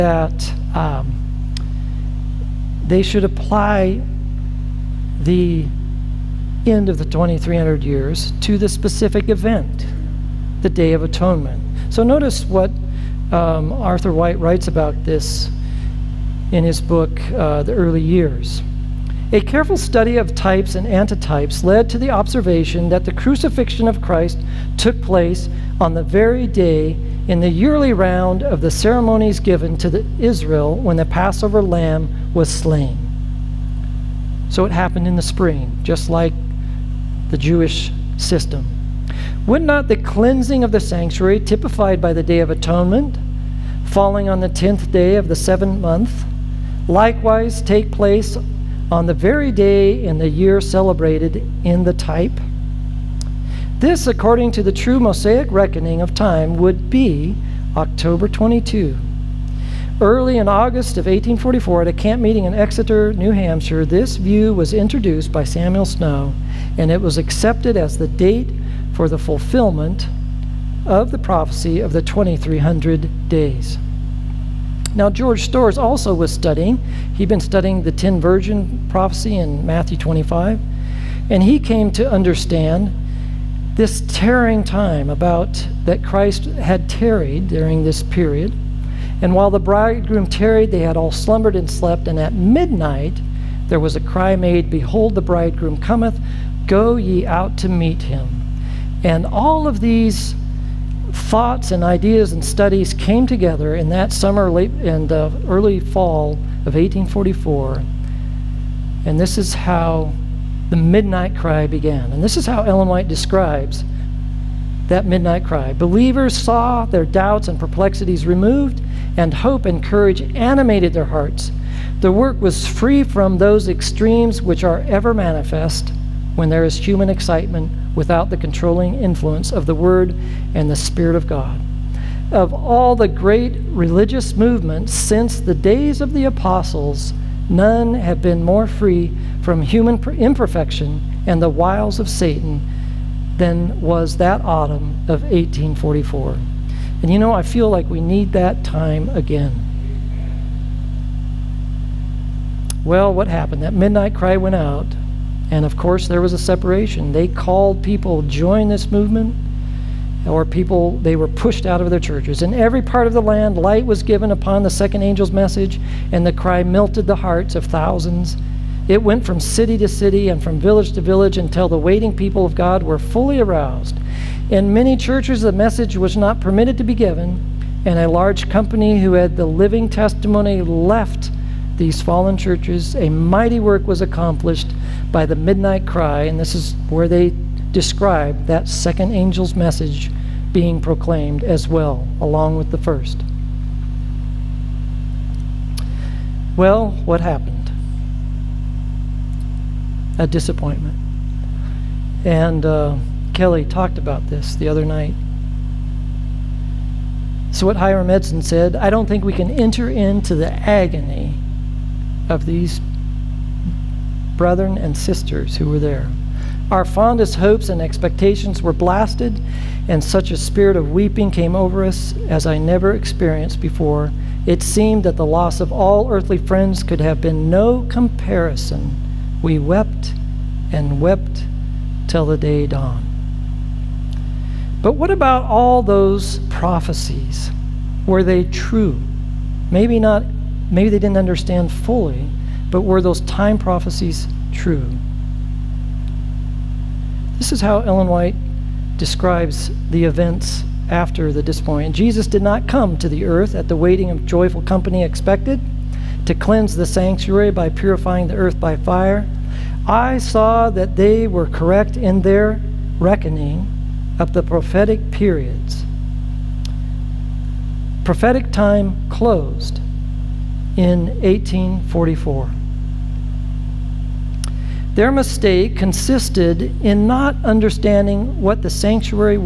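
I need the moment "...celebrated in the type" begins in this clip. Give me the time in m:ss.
0:50.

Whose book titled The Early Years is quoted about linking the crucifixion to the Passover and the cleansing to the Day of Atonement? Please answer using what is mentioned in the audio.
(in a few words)
Arthur White.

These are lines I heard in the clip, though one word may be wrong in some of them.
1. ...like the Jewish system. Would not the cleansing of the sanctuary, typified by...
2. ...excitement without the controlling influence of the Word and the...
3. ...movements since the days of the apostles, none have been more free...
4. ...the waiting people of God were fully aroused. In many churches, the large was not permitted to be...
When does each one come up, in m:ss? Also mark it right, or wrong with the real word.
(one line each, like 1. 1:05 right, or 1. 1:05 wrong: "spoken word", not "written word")
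1. 0:36 right
2. 2:07 right
3. 2:14 right
4. 2:51 wrong: "message", not "large".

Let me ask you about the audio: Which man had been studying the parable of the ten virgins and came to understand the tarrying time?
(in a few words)
George Storrs.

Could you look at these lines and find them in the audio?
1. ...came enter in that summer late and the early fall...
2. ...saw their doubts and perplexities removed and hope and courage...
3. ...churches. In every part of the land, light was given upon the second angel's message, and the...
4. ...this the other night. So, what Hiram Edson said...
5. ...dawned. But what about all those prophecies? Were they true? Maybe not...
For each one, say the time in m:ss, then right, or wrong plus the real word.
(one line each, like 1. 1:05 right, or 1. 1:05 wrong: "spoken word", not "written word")
1. 1:42 wrong: "together", not "enter"
2. 1:56 right
3. 2:41 right
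4. 3:24 right
5. 3:52 right.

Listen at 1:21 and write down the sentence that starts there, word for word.
And he came to understand this tarrying time about that Christ had tarried during this period.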